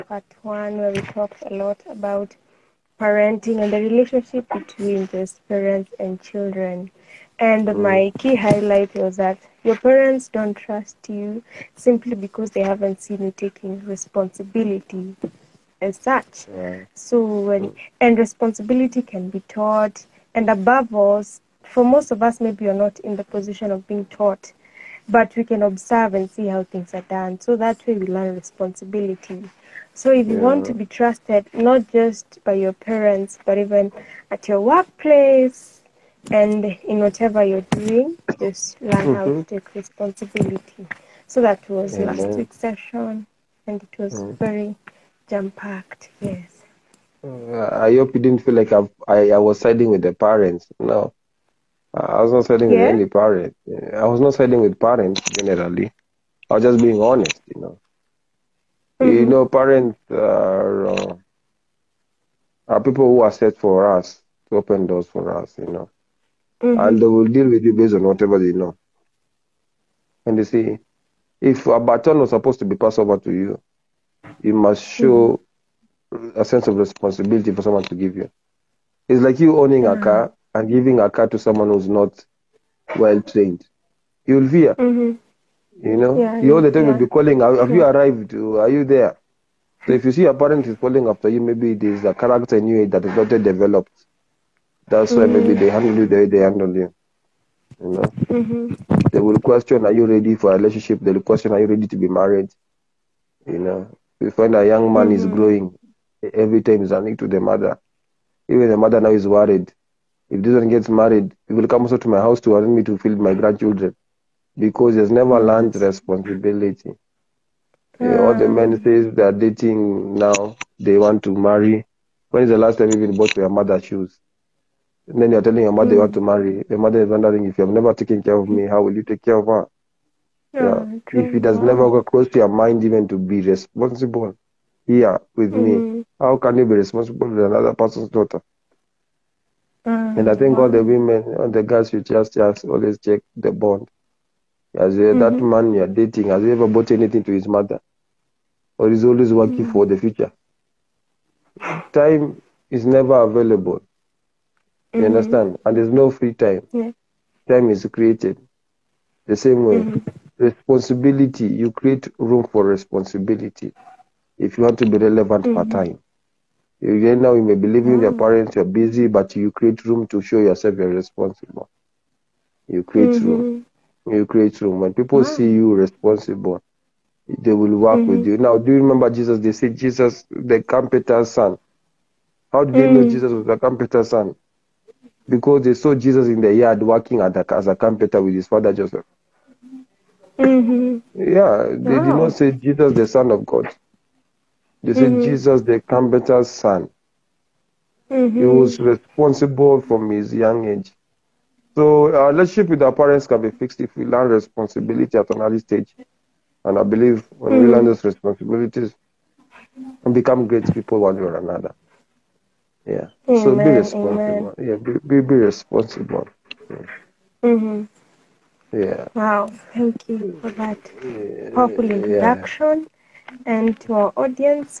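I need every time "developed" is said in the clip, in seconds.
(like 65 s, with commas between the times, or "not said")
93 s.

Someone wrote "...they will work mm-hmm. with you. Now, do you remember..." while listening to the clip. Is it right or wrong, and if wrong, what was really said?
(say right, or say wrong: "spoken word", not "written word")
right.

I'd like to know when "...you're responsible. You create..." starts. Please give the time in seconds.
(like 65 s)
170 s.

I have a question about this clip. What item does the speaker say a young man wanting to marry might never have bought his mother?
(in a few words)
Shoes.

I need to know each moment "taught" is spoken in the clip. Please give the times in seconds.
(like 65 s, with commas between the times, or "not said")
19 s, 24 s.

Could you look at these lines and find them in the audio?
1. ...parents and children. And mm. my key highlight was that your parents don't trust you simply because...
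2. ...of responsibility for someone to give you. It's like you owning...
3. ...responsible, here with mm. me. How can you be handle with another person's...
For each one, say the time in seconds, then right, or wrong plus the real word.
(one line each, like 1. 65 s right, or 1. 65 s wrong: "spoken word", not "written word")
1. 5 s right
2. 76 s right
3. 133 s wrong: "responsible", not "handle".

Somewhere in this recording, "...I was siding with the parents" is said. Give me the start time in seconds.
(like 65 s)
49 s.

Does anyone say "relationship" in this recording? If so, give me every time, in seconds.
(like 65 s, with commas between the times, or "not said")
3 s, 100 s, 202 s.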